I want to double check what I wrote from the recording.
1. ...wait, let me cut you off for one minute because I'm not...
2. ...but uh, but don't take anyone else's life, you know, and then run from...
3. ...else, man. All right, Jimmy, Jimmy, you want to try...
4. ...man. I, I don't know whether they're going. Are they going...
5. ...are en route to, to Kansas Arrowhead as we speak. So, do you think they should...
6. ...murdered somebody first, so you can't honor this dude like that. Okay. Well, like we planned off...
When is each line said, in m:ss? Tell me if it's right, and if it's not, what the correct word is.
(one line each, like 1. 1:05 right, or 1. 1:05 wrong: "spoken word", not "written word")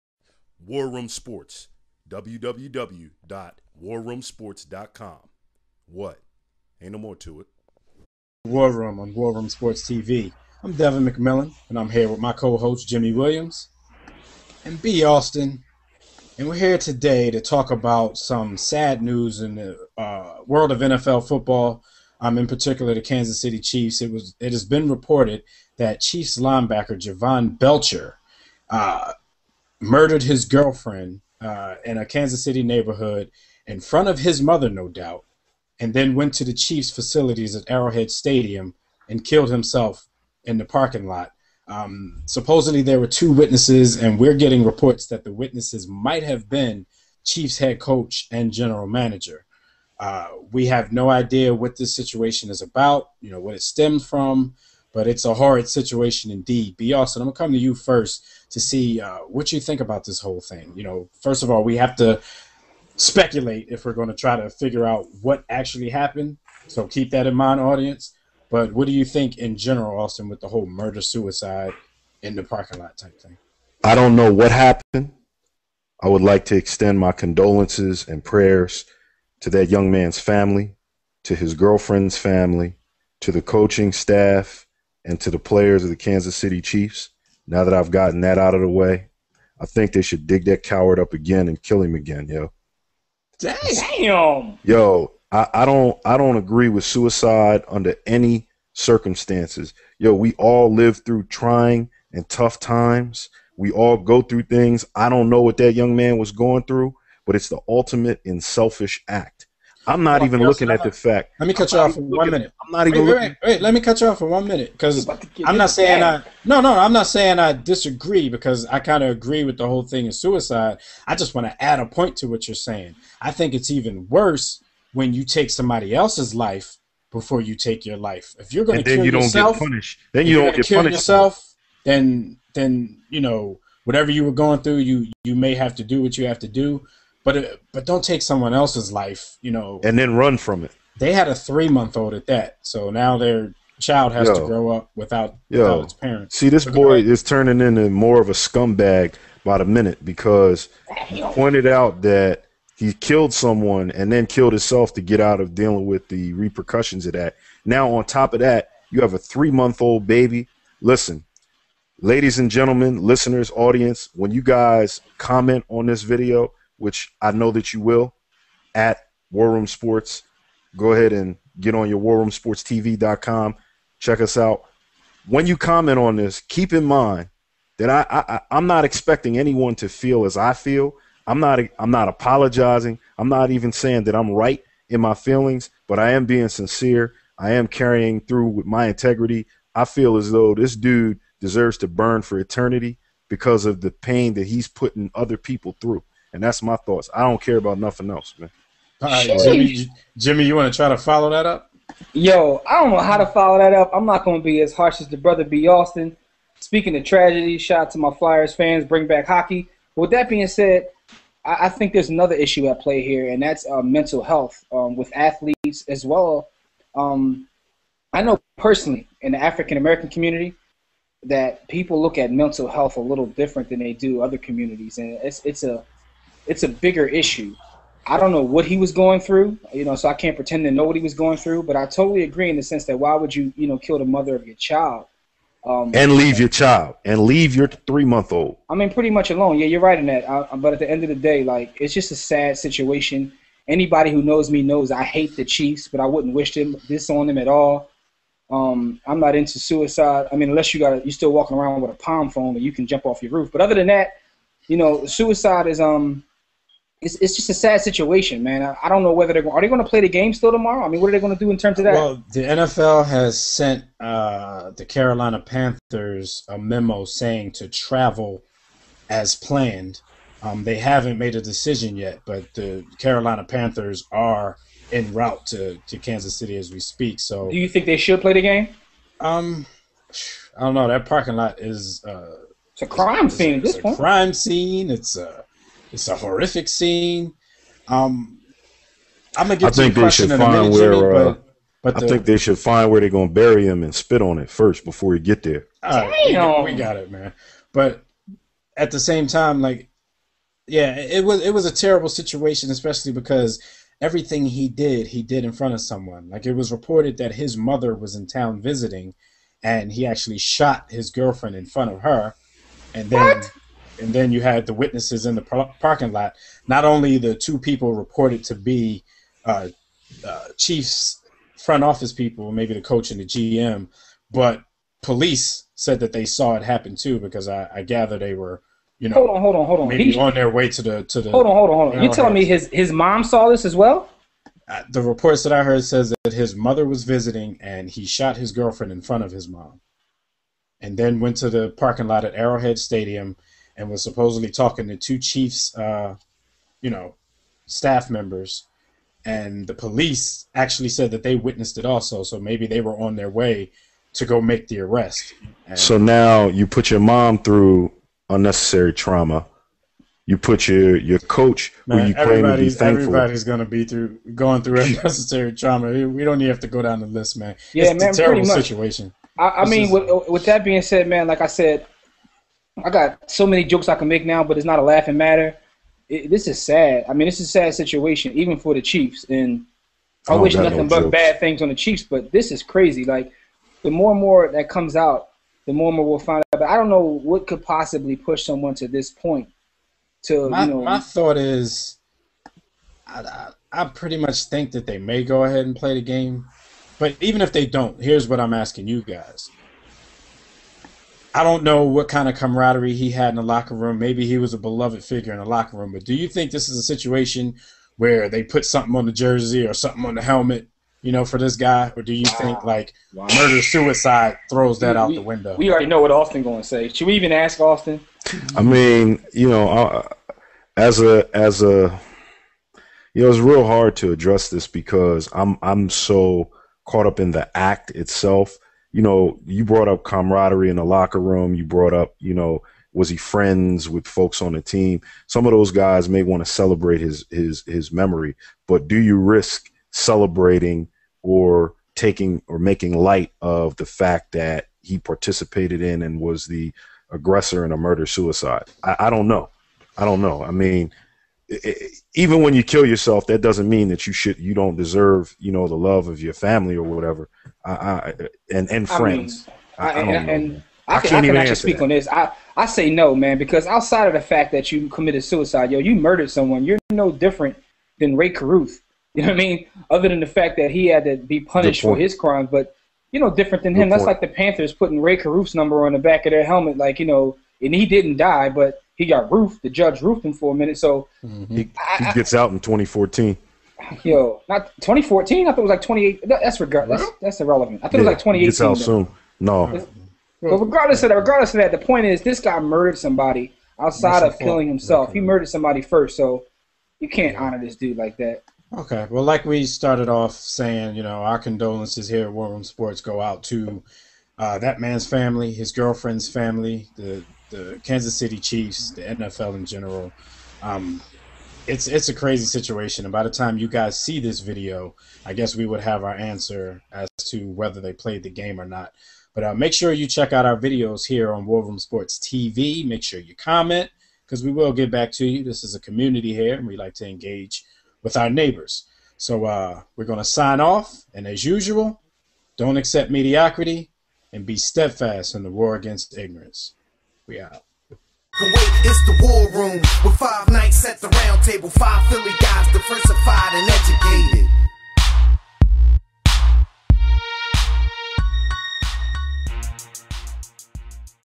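1. 1:53 right
2. 2:17 wrong: "someone", not "anyone"
3. 3:18 right
4. 4:18 right
5. 4:34 wrong: "City", not "Arrowhead"
6. 8:15 wrong: "started", not "planned".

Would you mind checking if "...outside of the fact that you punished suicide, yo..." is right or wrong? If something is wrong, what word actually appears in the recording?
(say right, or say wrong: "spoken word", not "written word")
wrong: "committed", not "punished".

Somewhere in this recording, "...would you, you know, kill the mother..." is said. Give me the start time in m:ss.
3:53.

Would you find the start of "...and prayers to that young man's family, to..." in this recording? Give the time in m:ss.
1:18.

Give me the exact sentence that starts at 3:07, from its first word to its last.
I am carrying through with my integrity.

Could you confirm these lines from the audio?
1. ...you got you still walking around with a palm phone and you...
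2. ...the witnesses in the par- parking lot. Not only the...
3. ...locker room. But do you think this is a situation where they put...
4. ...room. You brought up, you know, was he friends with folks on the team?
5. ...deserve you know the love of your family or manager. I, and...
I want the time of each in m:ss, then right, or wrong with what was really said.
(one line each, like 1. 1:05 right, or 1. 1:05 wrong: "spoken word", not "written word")
1. 4:10 right
2. 5:14 right
3. 6:45 right
4. 7:11 right
5. 7:34 wrong: "whatever", not "manager".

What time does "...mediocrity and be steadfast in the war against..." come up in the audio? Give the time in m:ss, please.
8:53.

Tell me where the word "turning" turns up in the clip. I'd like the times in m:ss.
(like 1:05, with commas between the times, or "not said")
2:27.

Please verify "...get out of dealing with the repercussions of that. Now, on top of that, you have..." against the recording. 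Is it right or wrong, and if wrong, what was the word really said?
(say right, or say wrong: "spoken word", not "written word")
right.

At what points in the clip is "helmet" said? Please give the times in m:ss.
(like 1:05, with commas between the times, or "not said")
6:50, 7:56.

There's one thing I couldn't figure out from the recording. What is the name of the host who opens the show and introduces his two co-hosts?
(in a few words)
Devin McMillan.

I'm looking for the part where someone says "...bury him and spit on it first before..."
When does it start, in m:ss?
4:53.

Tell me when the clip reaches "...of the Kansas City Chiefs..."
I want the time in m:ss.
1:25.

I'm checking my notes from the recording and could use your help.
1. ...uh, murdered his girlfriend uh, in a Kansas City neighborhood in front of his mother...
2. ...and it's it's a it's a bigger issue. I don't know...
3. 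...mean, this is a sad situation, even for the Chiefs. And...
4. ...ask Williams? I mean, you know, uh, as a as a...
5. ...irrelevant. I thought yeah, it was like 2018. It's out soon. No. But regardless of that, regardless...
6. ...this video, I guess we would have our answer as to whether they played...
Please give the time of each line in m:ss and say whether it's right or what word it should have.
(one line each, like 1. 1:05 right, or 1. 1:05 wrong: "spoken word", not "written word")
1. 0:28 right
2. 3:44 right
3. 6:17 right
4. 6:57 wrong: "Austin", not "Williams"
5. 8:07 right
6. 8:34 right.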